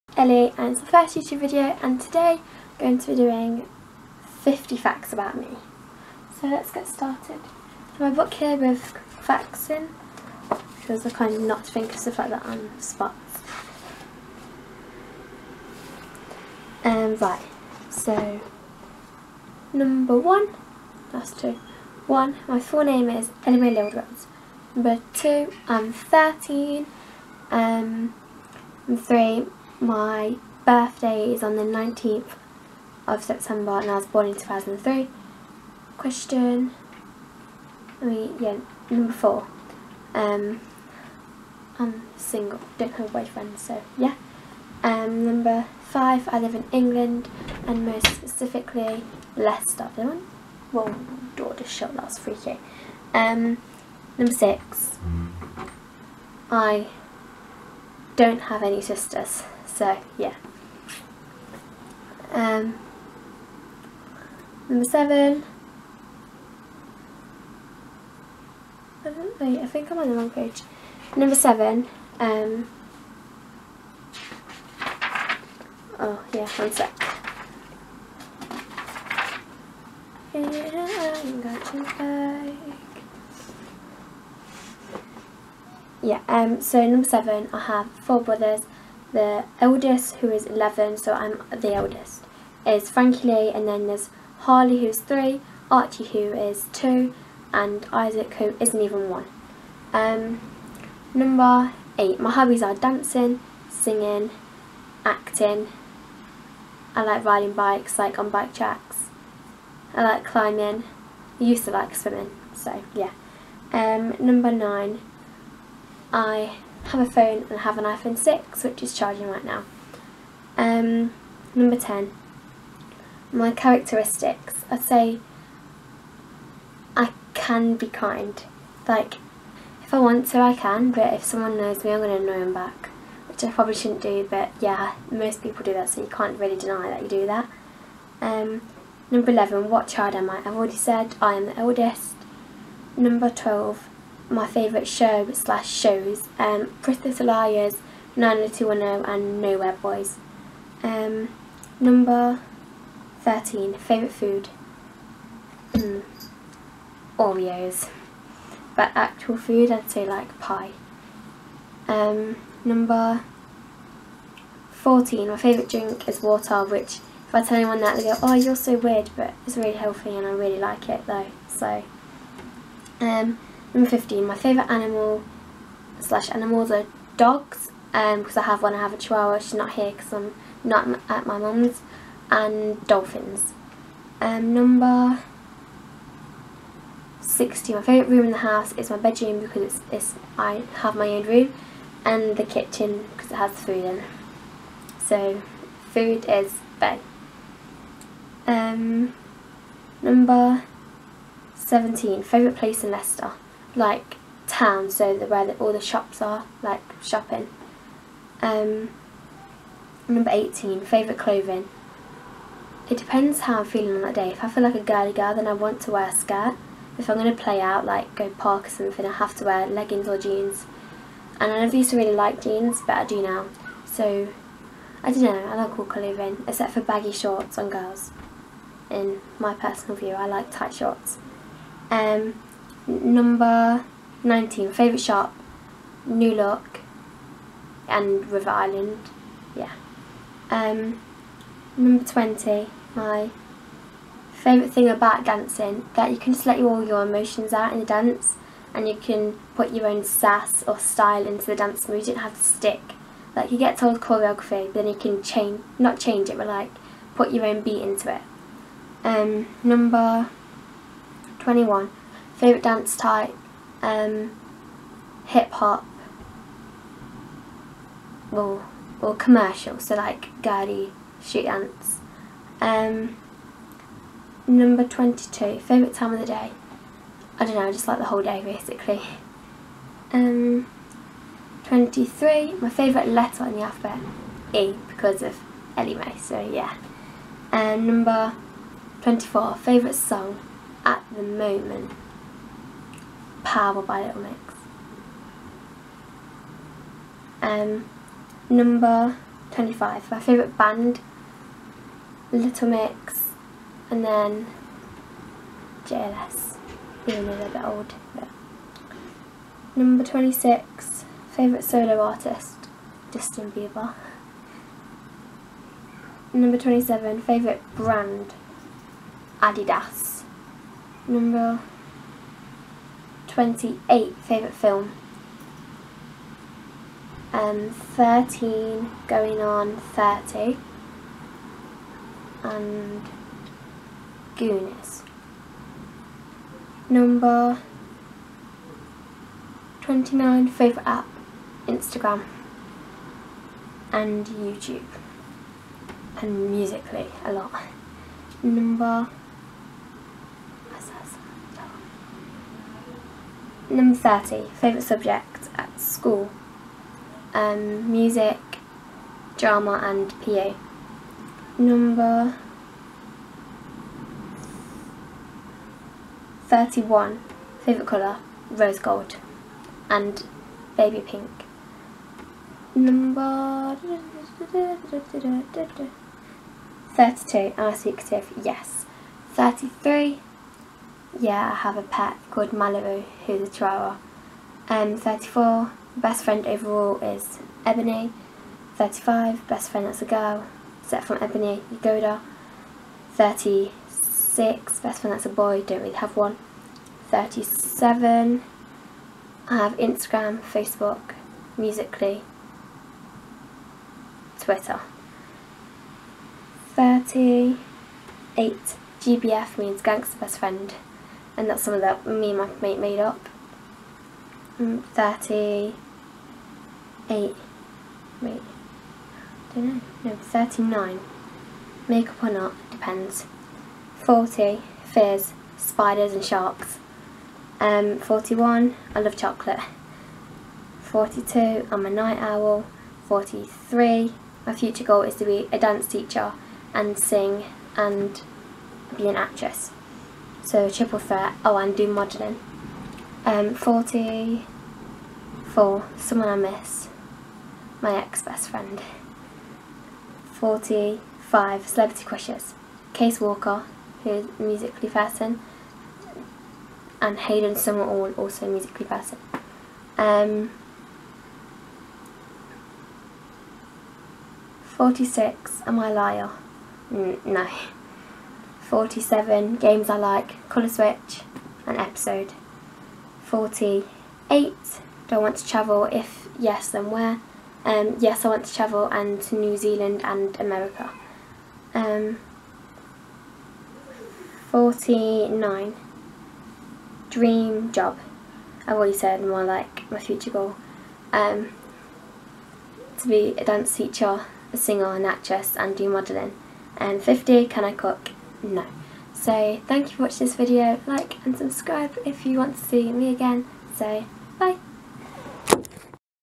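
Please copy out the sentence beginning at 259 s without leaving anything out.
Um, number 21, Favourite dance type?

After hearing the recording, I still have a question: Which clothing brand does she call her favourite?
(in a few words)
Adidas.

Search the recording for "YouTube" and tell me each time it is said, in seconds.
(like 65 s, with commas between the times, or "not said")
1 s, 344 s.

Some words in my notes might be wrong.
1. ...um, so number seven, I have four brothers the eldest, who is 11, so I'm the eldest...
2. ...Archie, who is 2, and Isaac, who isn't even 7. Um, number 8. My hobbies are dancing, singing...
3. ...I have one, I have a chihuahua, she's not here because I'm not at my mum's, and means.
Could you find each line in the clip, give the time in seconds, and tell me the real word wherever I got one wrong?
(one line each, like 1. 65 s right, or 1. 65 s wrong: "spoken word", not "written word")
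1. 86 s right
2. 95 s wrong: "1", not "7"
3. 178 s wrong: "dolphins", not "means".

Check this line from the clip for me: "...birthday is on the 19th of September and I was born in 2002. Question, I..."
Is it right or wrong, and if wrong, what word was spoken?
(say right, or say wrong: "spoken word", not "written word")
wrong: "2003", not "2002".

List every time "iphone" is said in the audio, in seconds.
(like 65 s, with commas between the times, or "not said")
117 s.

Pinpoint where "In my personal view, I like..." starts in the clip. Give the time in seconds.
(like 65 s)
228 s.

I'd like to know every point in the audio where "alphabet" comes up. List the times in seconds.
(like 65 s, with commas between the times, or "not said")
283 s.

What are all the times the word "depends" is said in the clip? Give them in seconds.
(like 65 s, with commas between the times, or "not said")
212 s, 422 s.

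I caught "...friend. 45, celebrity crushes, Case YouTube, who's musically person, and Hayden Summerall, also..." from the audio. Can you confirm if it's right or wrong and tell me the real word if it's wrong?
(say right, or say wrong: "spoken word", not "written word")
wrong: "Walker", not "YouTube".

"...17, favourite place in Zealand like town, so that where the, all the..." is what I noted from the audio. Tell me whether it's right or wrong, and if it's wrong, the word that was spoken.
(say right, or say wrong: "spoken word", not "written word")
wrong: "Leicester", not "Zealand".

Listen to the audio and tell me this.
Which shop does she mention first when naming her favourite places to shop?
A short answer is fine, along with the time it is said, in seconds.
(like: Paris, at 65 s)
New Look, at 236 s.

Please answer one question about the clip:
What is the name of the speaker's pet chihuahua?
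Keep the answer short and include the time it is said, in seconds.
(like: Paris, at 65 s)
Malibu, at 382 s.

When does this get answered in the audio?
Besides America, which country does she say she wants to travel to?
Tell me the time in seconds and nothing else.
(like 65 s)
479 s.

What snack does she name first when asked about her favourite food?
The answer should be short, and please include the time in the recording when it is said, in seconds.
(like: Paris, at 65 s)
Oreos, at 157 s.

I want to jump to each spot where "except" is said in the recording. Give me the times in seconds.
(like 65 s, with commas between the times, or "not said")
226 s, 390 s.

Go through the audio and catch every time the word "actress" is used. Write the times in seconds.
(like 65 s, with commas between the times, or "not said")
439 s, 495 s.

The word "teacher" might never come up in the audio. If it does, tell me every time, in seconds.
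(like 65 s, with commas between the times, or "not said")
435 s, 493 s.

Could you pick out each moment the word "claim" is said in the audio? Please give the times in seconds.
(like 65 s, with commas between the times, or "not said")
not said.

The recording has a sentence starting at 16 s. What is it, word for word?
Um, right, so number one, that's two.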